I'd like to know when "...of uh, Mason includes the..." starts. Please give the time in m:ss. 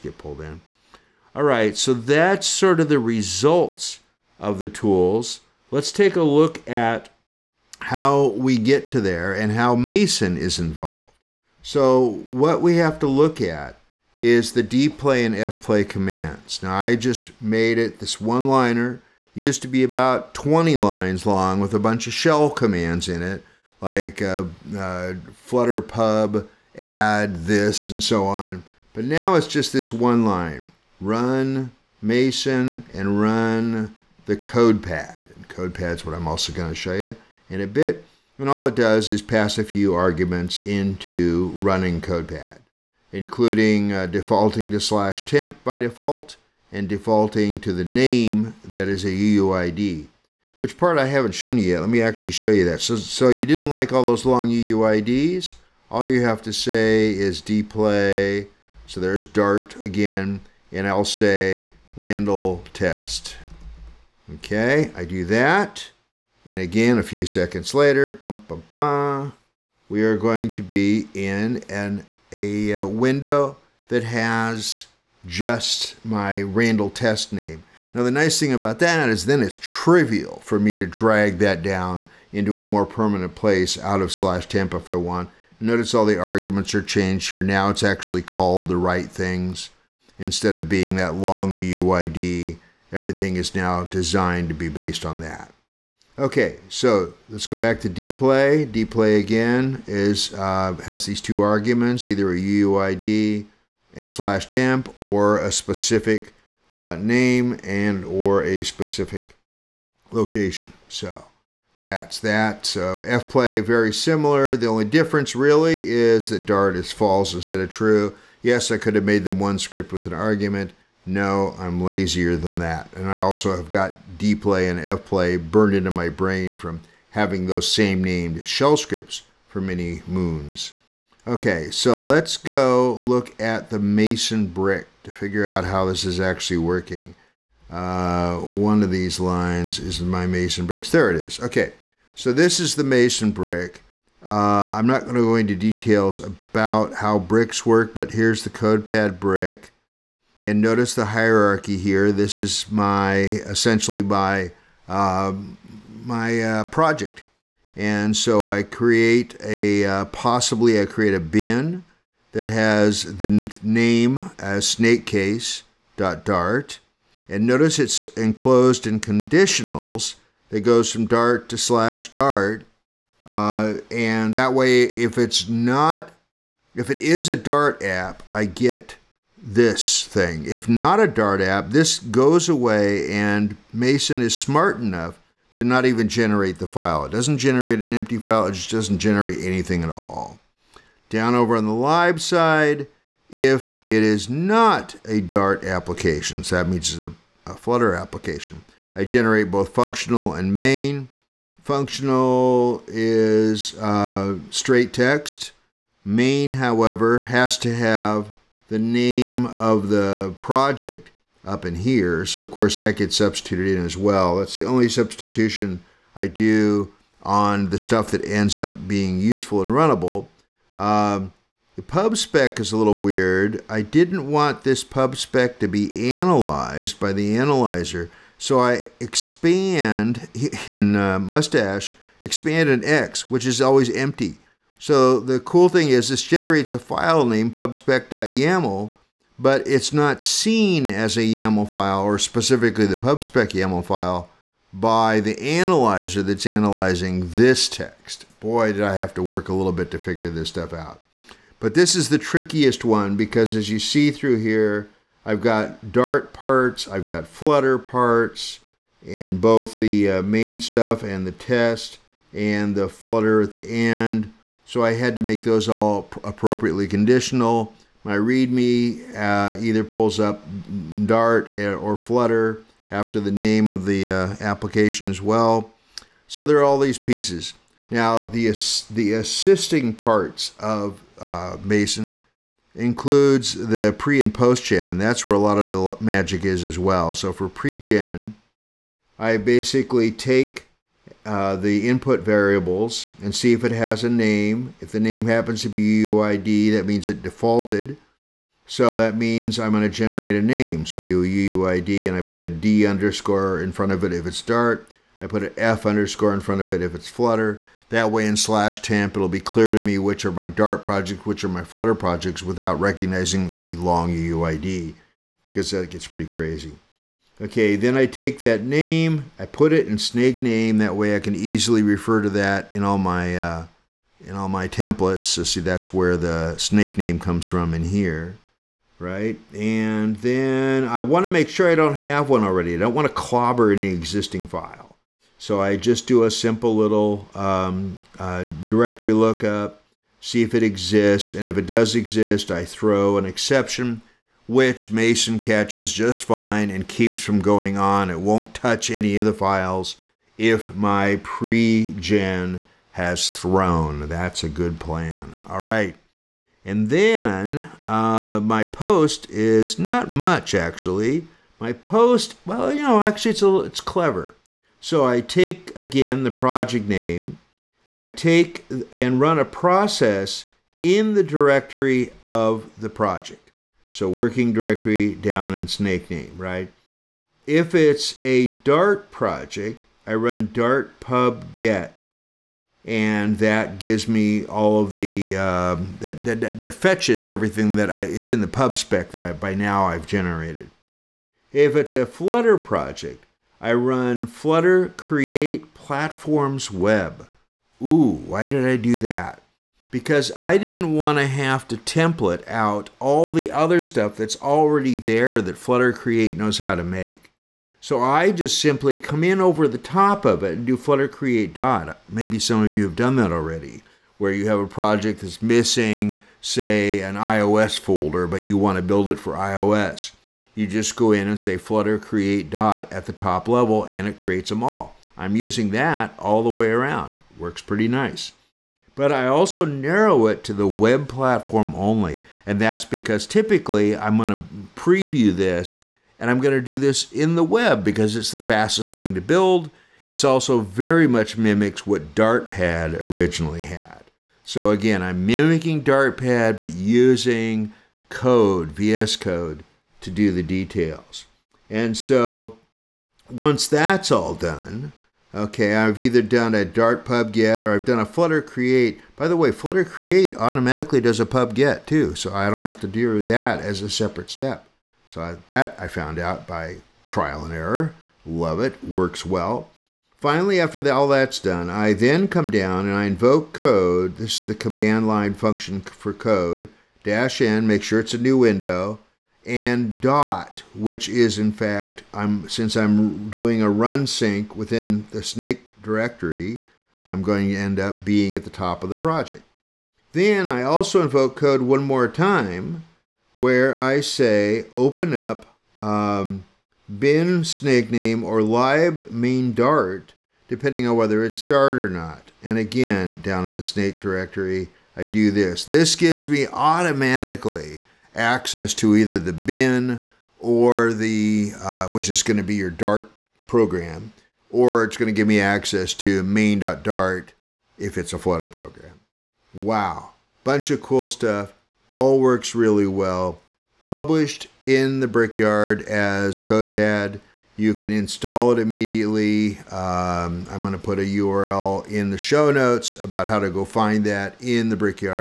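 4:40.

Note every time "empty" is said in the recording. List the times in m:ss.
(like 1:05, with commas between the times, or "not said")
3:07, 3:53.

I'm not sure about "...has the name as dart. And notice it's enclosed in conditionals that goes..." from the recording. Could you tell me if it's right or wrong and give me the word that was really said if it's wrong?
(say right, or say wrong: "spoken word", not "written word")
right.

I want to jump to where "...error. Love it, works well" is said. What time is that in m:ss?
7:47.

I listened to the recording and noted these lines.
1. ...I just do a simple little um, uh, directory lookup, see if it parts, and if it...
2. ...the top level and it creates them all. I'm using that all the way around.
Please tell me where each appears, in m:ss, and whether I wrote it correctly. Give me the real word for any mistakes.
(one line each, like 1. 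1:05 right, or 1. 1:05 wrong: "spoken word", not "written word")
1. 5:35 wrong: "exists", not "parts"
2. 7:03 right.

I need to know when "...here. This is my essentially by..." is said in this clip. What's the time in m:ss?
2:31.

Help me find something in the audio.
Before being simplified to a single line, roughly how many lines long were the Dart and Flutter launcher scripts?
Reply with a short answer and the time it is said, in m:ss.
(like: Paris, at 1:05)
About 20, at 0:19.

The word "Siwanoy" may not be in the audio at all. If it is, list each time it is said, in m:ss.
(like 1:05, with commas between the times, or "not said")
not said.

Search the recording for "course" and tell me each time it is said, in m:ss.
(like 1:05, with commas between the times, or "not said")
3:32.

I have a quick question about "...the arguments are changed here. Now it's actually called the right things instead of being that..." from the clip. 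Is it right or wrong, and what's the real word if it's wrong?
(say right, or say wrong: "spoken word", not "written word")
right.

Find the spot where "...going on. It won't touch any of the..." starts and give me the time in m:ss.
5:47.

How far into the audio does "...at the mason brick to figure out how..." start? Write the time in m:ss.
2:13.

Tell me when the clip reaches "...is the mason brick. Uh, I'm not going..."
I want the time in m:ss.
2:22.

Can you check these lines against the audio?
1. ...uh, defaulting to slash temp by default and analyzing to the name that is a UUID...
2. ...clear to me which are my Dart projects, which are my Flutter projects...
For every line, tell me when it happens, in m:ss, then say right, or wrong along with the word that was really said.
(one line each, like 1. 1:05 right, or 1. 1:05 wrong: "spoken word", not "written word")
1. 0:43 wrong: "defaulting", not "analyzing"
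2. 5:09 right.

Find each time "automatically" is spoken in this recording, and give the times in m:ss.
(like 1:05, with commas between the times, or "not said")
7:40, 8:26.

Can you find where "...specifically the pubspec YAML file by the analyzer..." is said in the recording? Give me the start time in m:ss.
4:02.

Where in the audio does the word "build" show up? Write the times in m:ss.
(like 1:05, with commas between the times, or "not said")
6:58, 7:19.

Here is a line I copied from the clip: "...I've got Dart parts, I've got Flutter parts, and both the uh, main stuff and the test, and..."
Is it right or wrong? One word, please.
right.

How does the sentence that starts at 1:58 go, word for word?
Yes, I could have made them one script with an argument, no, I'm lazier than that.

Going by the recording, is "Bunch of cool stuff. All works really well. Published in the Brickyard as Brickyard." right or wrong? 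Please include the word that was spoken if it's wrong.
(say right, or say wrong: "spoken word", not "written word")
wrong: "CodePad", not "Brickyard".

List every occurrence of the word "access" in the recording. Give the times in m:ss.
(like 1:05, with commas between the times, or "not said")
8:28, 8:35.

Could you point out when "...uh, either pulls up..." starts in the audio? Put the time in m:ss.
4:29.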